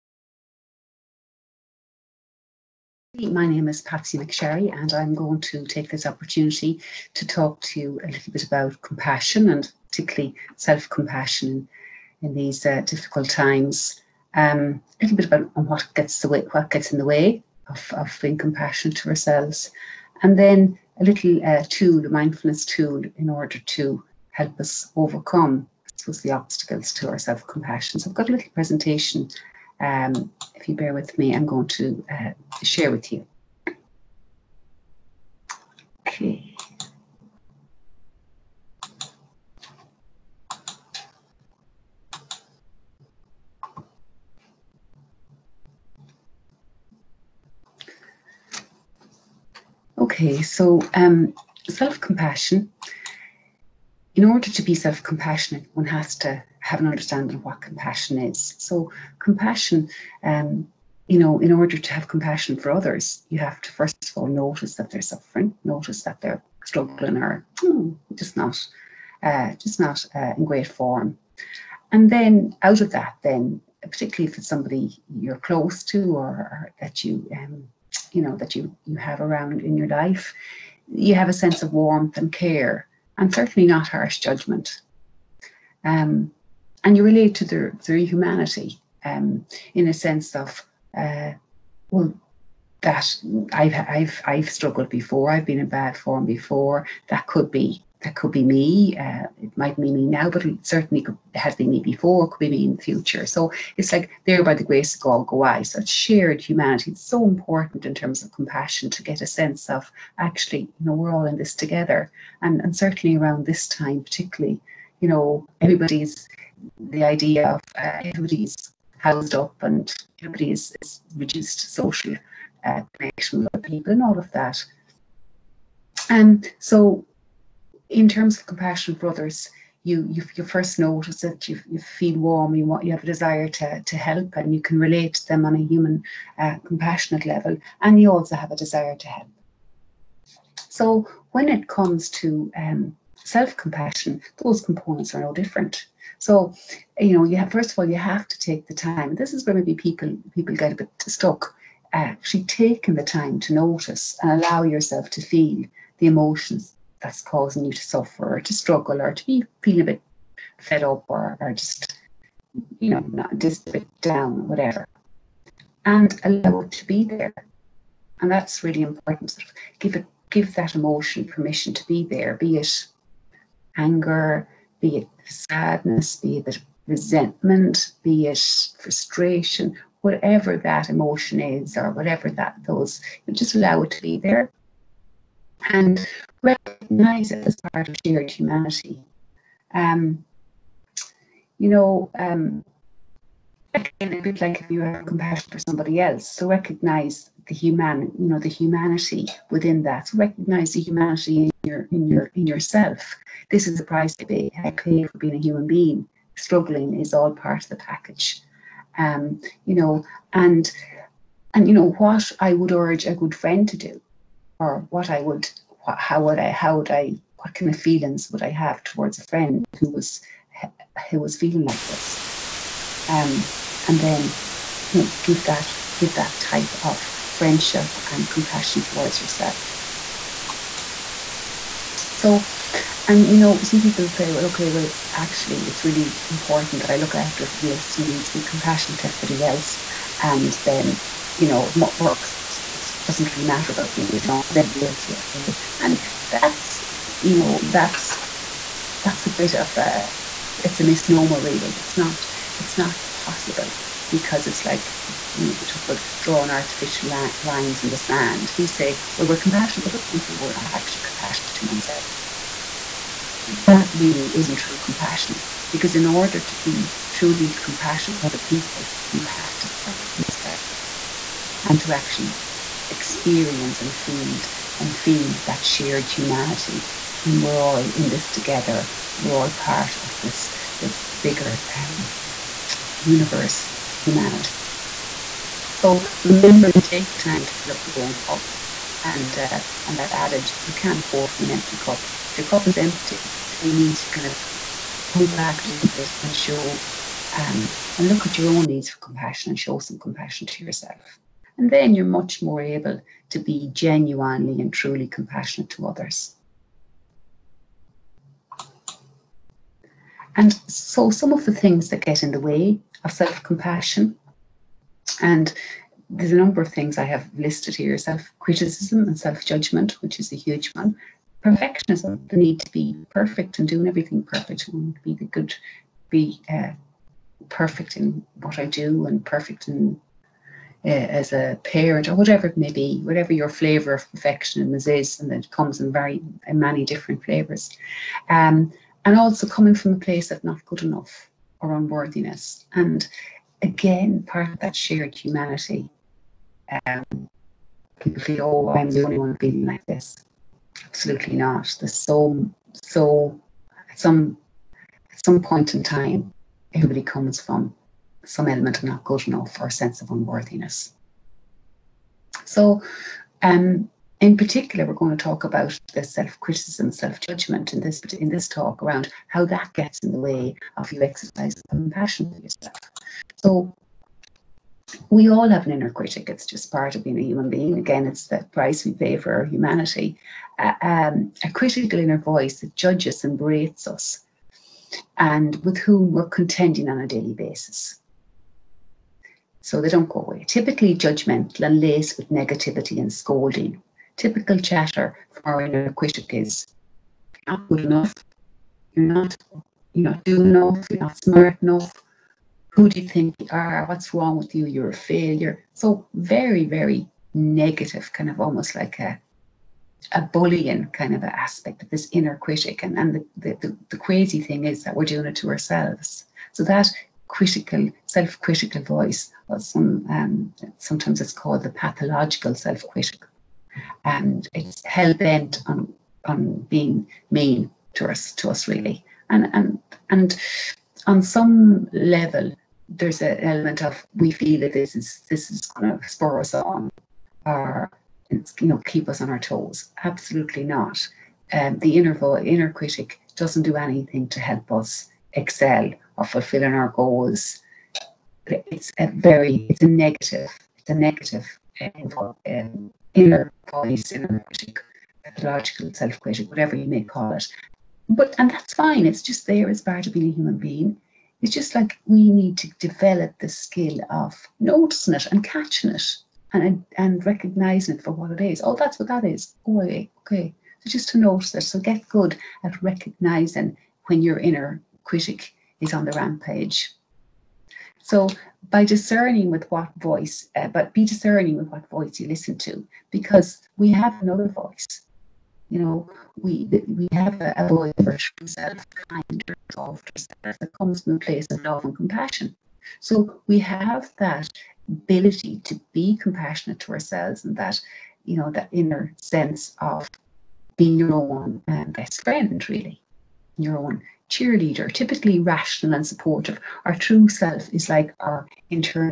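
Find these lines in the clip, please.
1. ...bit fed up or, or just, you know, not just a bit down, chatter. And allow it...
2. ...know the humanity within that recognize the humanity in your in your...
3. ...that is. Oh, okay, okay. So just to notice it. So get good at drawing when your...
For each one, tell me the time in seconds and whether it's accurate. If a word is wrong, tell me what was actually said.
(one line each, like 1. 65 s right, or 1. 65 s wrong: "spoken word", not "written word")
1. 159 s wrong: "whatever", not "chatter"
2. 198 s right
3. 469 s wrong: "recognizing", not "drawing".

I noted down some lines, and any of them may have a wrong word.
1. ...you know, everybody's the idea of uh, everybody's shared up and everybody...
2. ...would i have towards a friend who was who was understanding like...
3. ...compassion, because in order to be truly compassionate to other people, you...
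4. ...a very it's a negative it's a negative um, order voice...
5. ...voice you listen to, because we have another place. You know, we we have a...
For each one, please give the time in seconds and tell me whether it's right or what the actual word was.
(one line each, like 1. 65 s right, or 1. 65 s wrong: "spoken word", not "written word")
1. 114 s wrong: "housed", not "shared"
2. 218 s wrong: "feeling", not "understanding"
3. 264 s right
4. 448 s wrong: "inner", not "order"
5. 481 s wrong: "voice", not "place".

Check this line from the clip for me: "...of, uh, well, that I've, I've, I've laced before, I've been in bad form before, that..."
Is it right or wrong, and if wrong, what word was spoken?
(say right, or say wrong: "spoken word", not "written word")
wrong: "struggled", not "laced".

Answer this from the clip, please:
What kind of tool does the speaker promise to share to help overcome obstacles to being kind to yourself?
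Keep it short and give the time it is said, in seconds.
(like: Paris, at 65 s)
mindfulness tool, at 22 s.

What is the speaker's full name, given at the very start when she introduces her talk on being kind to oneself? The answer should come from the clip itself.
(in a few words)
Patsy McSharry.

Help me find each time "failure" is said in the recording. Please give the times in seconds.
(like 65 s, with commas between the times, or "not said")
404 s.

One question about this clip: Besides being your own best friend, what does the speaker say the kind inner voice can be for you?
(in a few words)
your own cheerleader.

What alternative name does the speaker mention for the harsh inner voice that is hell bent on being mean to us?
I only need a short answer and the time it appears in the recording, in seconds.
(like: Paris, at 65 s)
pathological self-critical, at 421 s.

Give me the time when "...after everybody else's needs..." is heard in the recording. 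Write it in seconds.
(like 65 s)
237 s.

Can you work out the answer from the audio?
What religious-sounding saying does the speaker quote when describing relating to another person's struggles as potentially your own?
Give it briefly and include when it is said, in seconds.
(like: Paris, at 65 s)
there by the grace of God go I, at 104 s.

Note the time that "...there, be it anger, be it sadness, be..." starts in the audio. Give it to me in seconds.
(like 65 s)
172 s.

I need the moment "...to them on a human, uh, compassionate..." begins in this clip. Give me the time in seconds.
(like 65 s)
135 s.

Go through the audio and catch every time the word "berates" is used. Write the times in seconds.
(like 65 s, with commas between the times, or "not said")
383 s.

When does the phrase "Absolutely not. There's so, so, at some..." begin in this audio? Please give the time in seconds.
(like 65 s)
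350 s.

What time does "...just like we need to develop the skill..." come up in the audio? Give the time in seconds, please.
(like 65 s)
461 s.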